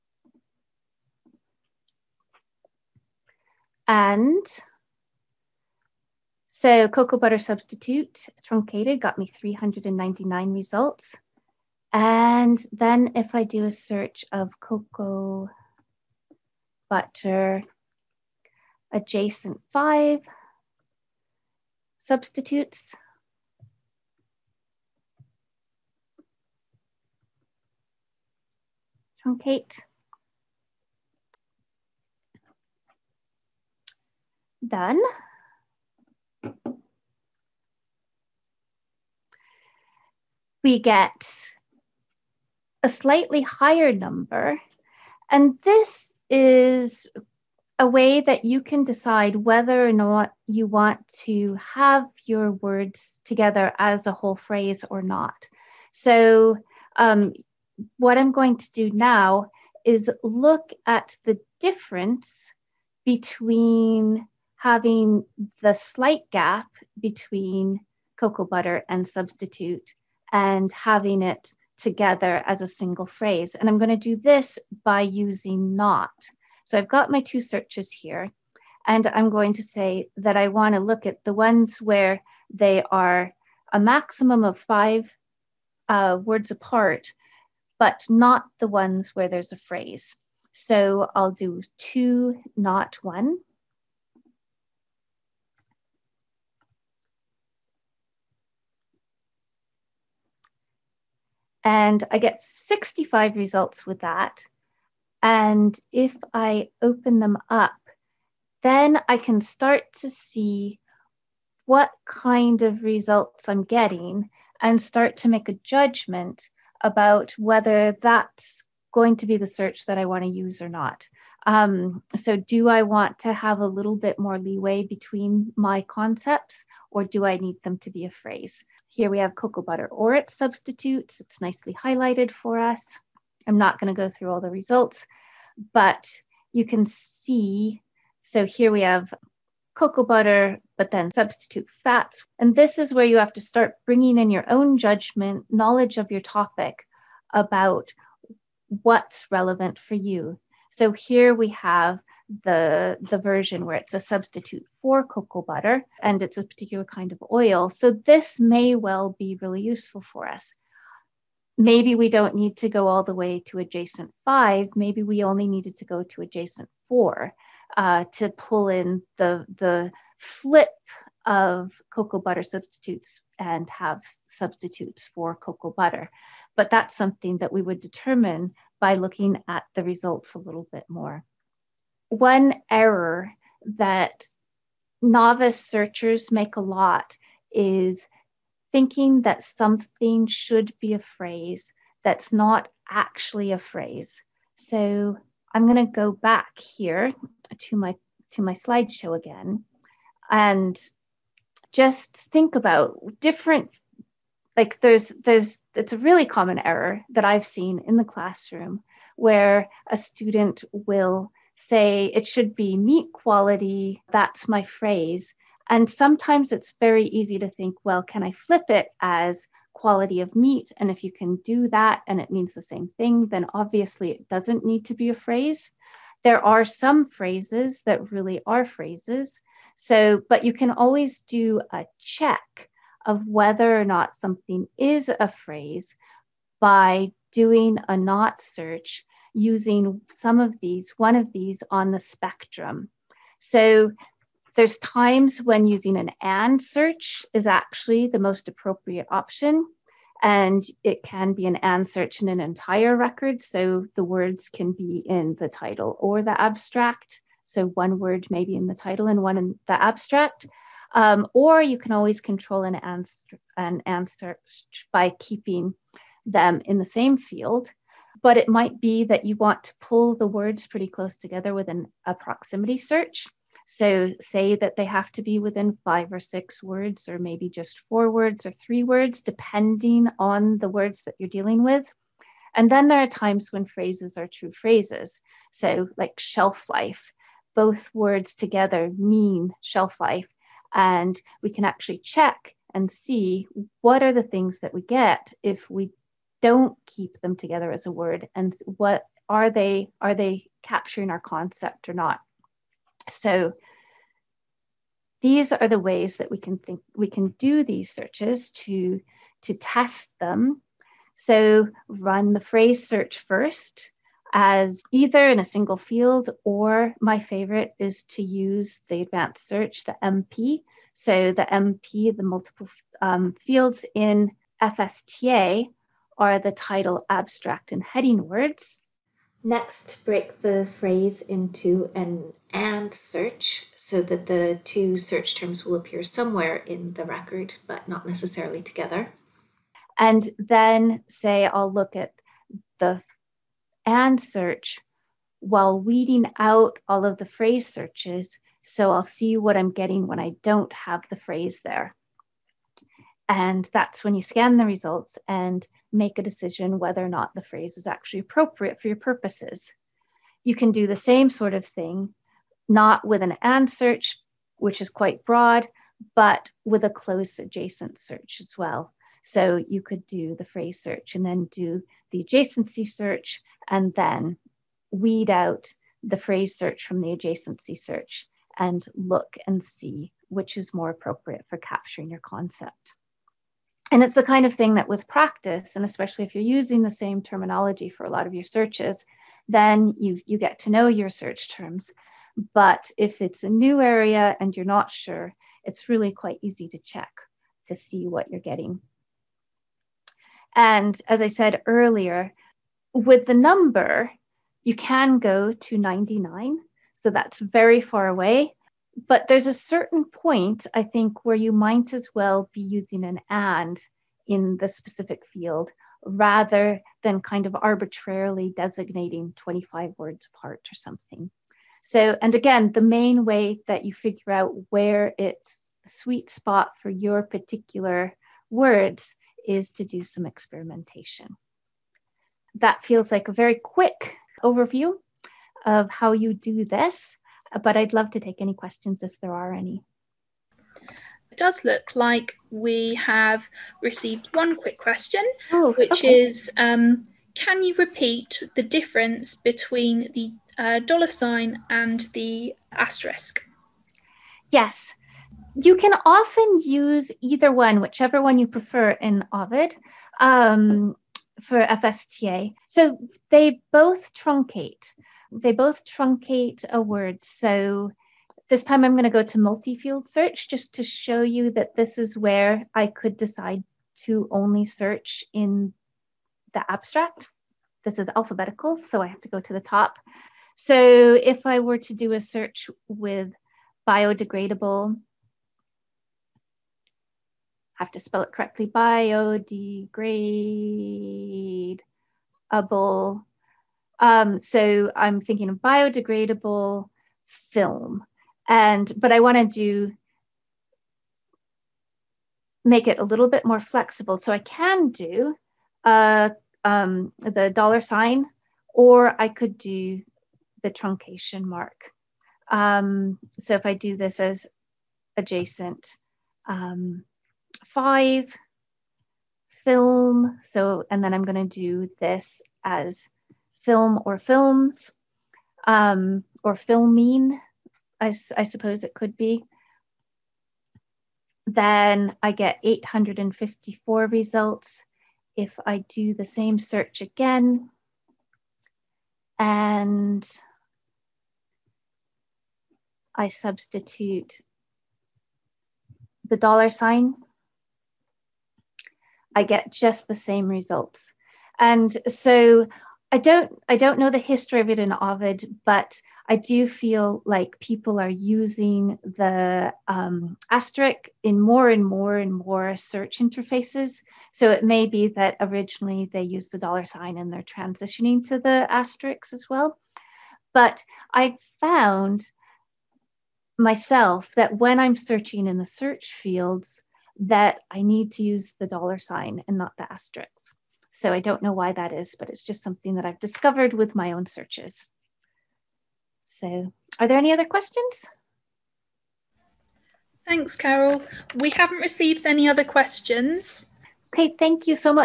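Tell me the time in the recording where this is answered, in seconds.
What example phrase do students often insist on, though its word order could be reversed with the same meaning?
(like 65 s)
212 s.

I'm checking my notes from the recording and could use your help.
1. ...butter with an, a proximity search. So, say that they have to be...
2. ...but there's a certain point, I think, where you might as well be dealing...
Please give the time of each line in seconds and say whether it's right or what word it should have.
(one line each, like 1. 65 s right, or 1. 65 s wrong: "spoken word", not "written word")
1. 271 s wrong: "together", not "butter"
2. 409 s wrong: "using", not "dealing".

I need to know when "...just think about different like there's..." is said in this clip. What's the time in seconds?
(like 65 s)
201 s.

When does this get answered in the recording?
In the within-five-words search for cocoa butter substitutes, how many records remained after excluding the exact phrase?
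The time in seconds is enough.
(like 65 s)
102 s.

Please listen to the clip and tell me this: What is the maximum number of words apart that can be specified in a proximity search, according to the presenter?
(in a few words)
99.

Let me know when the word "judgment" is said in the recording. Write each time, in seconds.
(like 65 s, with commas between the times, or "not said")
115 s, 144 s.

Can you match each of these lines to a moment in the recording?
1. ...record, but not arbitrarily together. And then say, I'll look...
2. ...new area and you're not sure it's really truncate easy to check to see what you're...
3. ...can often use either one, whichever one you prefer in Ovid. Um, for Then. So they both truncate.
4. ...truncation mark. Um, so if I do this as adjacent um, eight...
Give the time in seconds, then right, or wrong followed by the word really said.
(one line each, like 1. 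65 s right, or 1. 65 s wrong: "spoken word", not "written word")
1. 337 s wrong: "necessarily", not "arbitrarily"
2. 393 s wrong: "quite", not "truncate"
3. 455 s wrong: "FSTA", not "Then"
4. 510 s wrong: "five", not "eight".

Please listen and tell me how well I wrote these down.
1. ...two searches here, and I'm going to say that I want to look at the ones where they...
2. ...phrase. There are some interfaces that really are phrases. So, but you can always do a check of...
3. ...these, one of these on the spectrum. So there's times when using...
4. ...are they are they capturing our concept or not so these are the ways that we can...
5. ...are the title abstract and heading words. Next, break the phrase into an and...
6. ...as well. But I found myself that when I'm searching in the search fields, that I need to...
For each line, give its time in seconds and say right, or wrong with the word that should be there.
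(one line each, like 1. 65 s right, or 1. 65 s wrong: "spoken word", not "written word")
1. 77 s right
2. 225 s wrong: "phrases", not "interfaces"
3. 240 s right
4. 299 s right
5. 326 s right
6. 569 s right.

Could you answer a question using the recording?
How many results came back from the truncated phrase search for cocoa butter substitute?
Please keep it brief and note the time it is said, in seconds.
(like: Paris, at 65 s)
399, at 9 s.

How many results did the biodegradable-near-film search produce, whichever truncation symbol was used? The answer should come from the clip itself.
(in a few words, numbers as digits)
854.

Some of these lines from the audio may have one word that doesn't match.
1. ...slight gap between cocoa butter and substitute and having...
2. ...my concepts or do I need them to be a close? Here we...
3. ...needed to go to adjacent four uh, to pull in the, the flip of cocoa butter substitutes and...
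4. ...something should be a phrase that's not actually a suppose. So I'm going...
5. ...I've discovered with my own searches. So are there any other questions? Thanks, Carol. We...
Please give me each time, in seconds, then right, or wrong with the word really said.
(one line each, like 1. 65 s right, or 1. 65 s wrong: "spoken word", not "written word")
1. 65 s right
2. 125 s wrong: "phrase", not "close"
3. 165 s right
4. 189 s wrong: "phrase", not "suppose"
5. 583 s right.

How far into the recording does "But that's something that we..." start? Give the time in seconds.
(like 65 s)
176 s.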